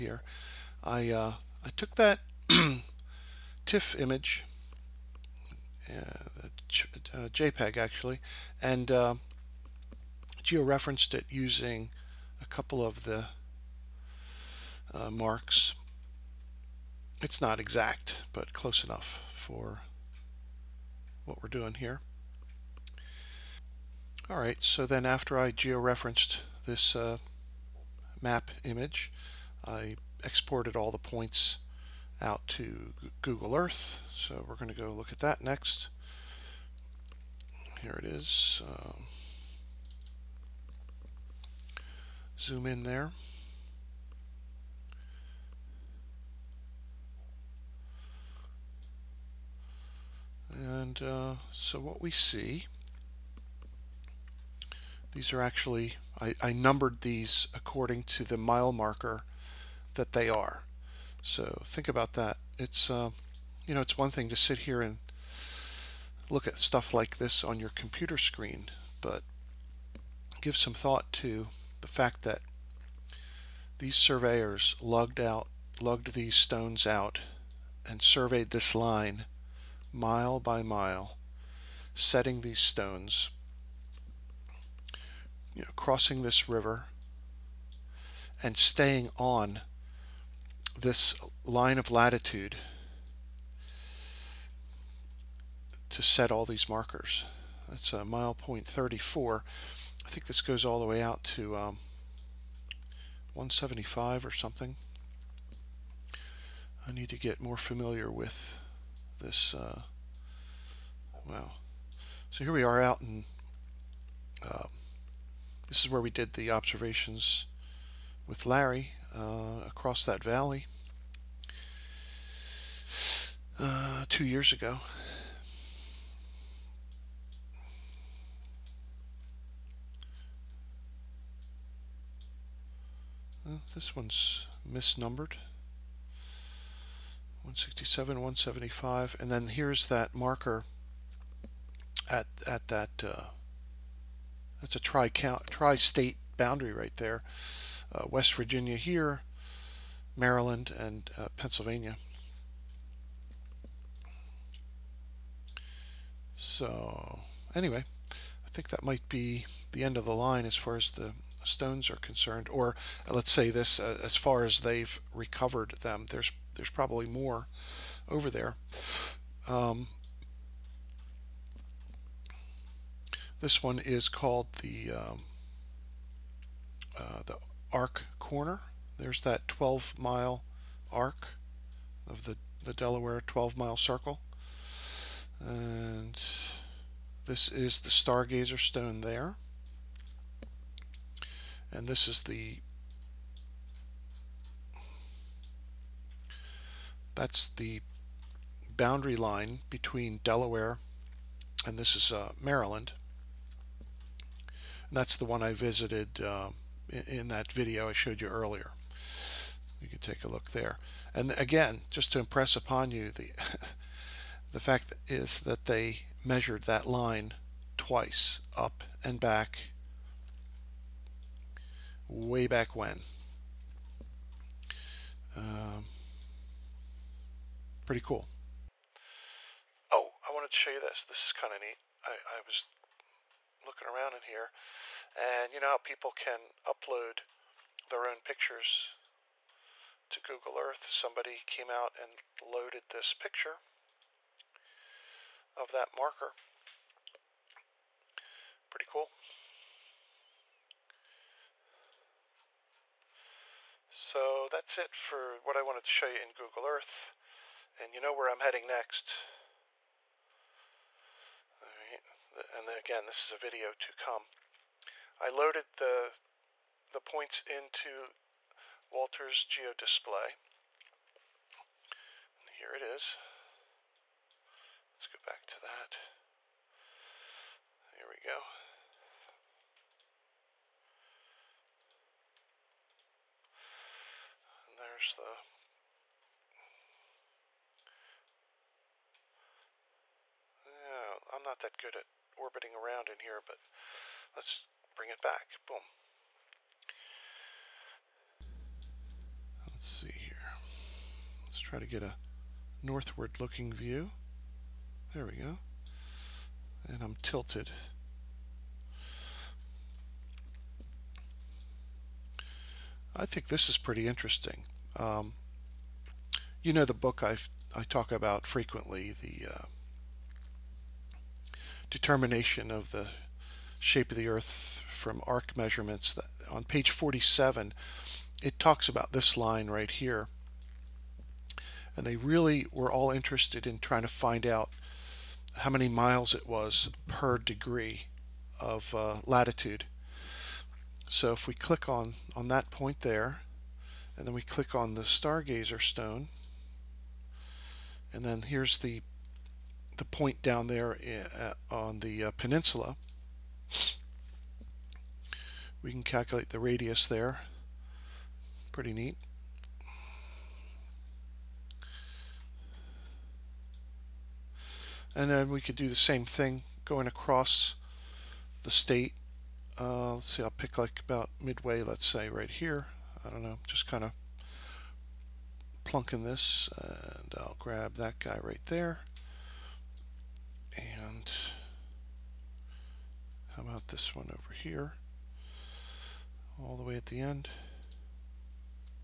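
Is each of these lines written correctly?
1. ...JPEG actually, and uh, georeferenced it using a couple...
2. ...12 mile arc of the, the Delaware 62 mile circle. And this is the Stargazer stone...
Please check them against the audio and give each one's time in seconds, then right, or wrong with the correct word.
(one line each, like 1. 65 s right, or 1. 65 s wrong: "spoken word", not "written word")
1. 7 s right
2. 179 s wrong: "12", not "62".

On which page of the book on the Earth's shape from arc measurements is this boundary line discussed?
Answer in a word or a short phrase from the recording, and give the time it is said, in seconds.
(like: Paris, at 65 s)
47, at 326 s.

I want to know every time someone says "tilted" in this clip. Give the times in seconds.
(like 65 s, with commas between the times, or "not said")
307 s.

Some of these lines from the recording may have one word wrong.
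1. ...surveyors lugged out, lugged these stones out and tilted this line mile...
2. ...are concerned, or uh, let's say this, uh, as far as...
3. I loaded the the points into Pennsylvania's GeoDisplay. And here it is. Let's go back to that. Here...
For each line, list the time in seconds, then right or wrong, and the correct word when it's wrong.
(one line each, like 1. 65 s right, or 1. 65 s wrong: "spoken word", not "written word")
1. 73 s wrong: "surveyed", not "tilted"
2. 161 s right
3. 265 s wrong: "Walter", not "Pennsylvania".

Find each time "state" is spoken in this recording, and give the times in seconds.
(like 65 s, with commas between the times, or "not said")
145 s, 368 s.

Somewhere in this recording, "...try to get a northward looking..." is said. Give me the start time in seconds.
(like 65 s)
301 s.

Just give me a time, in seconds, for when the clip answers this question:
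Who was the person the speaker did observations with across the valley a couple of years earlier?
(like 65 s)
118 s.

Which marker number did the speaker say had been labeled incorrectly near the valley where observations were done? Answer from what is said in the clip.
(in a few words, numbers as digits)
167.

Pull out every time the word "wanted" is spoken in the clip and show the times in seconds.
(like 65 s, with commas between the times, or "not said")
230 s, 255 s.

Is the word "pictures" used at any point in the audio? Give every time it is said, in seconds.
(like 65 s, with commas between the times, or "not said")
238 s, 243 s.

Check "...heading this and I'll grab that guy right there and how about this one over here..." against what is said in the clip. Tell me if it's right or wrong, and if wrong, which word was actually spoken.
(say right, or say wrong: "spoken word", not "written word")
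wrong: "plunking", not "heading".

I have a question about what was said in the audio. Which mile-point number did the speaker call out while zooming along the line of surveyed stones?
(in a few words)
34.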